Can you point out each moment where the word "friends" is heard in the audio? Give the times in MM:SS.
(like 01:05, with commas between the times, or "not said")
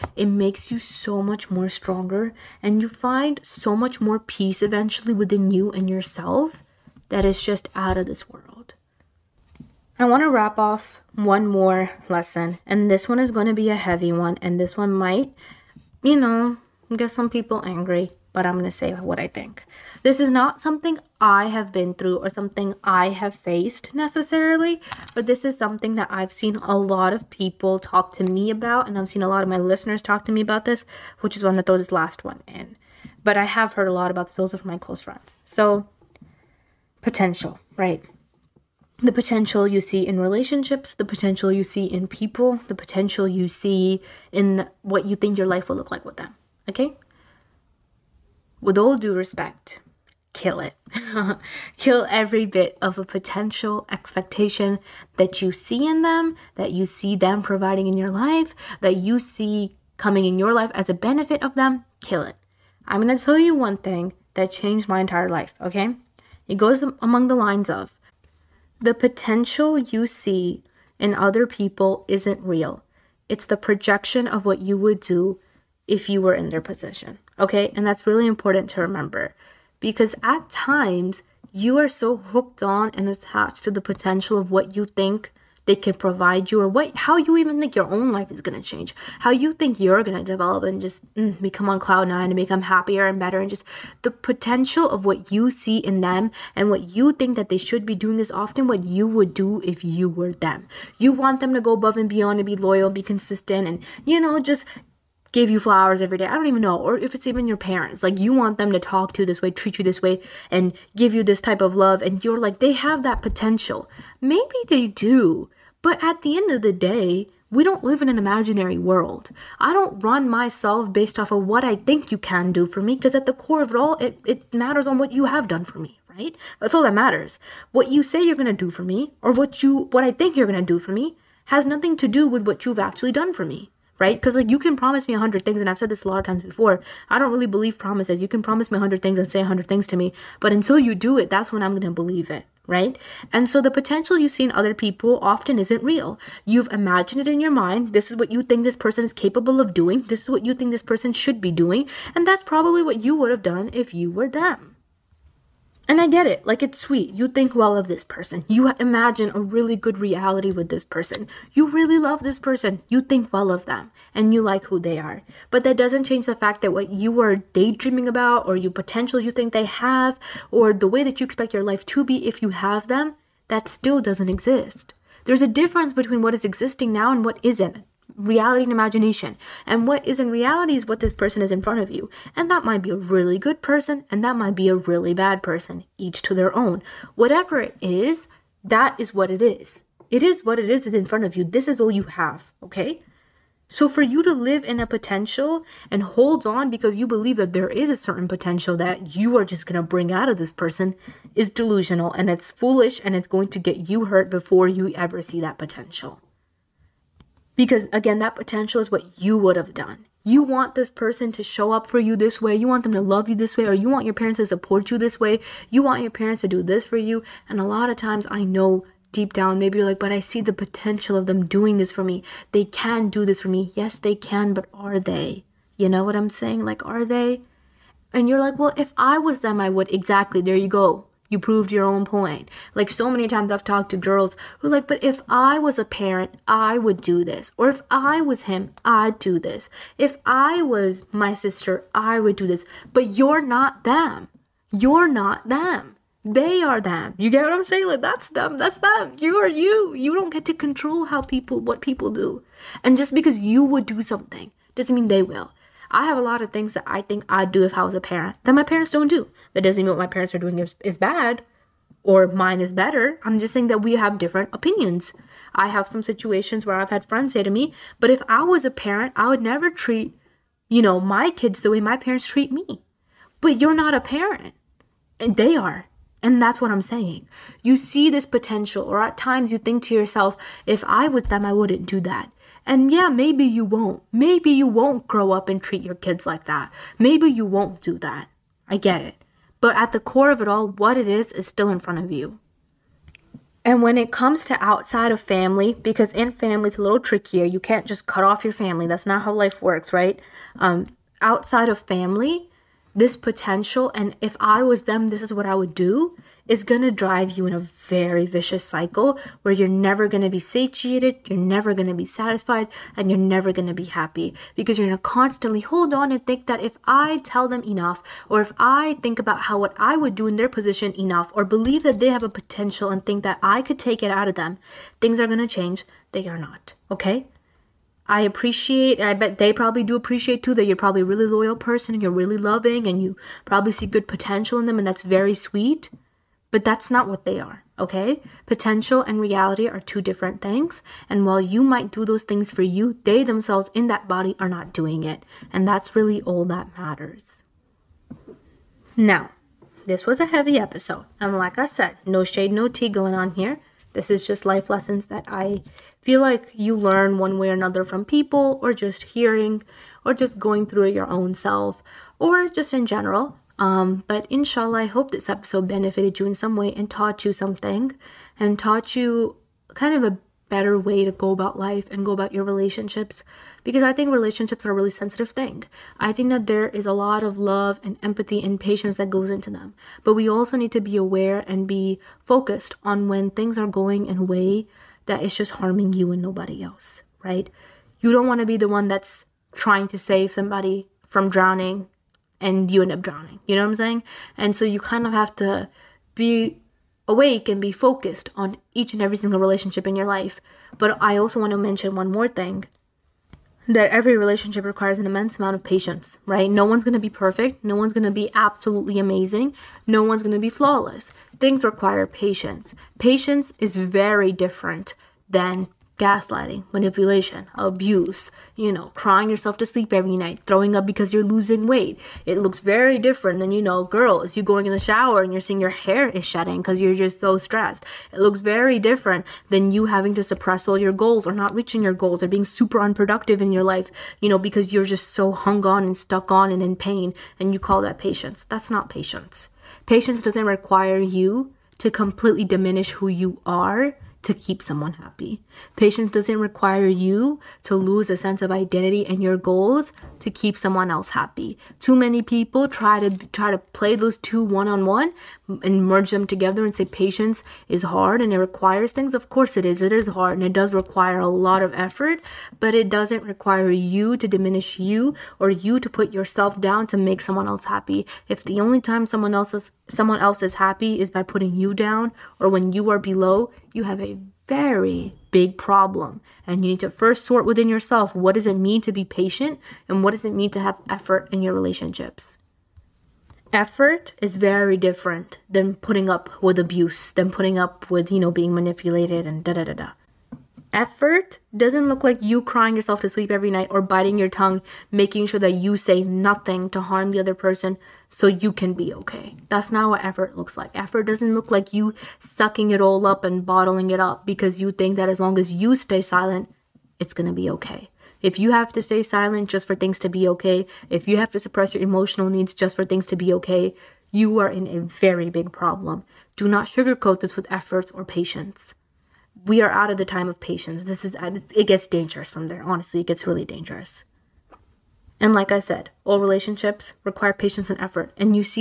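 00:35, 04:27.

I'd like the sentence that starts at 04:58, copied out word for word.
That's not how life works, right?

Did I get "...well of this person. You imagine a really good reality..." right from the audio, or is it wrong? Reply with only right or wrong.
right.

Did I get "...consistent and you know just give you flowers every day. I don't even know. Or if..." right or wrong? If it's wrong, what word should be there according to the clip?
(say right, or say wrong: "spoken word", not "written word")
right.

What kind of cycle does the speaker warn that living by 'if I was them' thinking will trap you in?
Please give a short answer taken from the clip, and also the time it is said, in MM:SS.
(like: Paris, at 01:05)
Vicious cycle, at 05:08.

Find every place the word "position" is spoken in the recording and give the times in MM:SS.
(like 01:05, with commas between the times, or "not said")
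01:16, 05:20.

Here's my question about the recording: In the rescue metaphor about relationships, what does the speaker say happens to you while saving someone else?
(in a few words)
You end up drowning.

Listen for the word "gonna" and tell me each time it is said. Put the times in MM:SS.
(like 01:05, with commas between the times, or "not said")
02:21, 08:27.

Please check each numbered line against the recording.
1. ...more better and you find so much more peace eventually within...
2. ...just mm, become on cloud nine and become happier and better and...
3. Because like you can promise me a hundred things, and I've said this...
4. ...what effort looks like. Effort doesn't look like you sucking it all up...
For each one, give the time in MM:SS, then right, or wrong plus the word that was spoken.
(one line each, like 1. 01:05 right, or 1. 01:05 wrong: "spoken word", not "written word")
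1. 00:01 wrong: "stronger", not "better"
2. 01:30 right
3. 02:14 right
4. 08:19 right.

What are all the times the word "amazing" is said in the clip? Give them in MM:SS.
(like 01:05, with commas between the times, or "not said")
06:48.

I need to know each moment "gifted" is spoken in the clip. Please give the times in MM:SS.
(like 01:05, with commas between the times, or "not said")
not said.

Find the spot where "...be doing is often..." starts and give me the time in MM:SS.
01:37.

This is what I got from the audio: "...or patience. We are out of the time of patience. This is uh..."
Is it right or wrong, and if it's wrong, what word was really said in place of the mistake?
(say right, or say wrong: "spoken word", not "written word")
right.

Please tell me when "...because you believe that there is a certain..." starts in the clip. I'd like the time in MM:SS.
03:16.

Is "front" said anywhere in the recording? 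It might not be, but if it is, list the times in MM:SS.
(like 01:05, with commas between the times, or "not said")
03:01, 03:11, 04:51.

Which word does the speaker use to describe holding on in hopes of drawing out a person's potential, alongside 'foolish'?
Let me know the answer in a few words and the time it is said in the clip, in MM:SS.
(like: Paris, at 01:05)
Delusional, at 03:21.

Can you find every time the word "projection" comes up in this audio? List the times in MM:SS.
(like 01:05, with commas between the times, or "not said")
01:13.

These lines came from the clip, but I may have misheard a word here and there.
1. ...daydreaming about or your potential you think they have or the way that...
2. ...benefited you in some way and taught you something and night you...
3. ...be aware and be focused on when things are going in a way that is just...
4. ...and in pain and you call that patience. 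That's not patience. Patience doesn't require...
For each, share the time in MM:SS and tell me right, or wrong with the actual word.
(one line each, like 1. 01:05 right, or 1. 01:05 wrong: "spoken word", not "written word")
1. 02:47 right
2. 06:05 wrong: "taught", not "night"
3. 06:20 right
4. 07:16 right.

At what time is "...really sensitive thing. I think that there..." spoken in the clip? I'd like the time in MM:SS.
06:14.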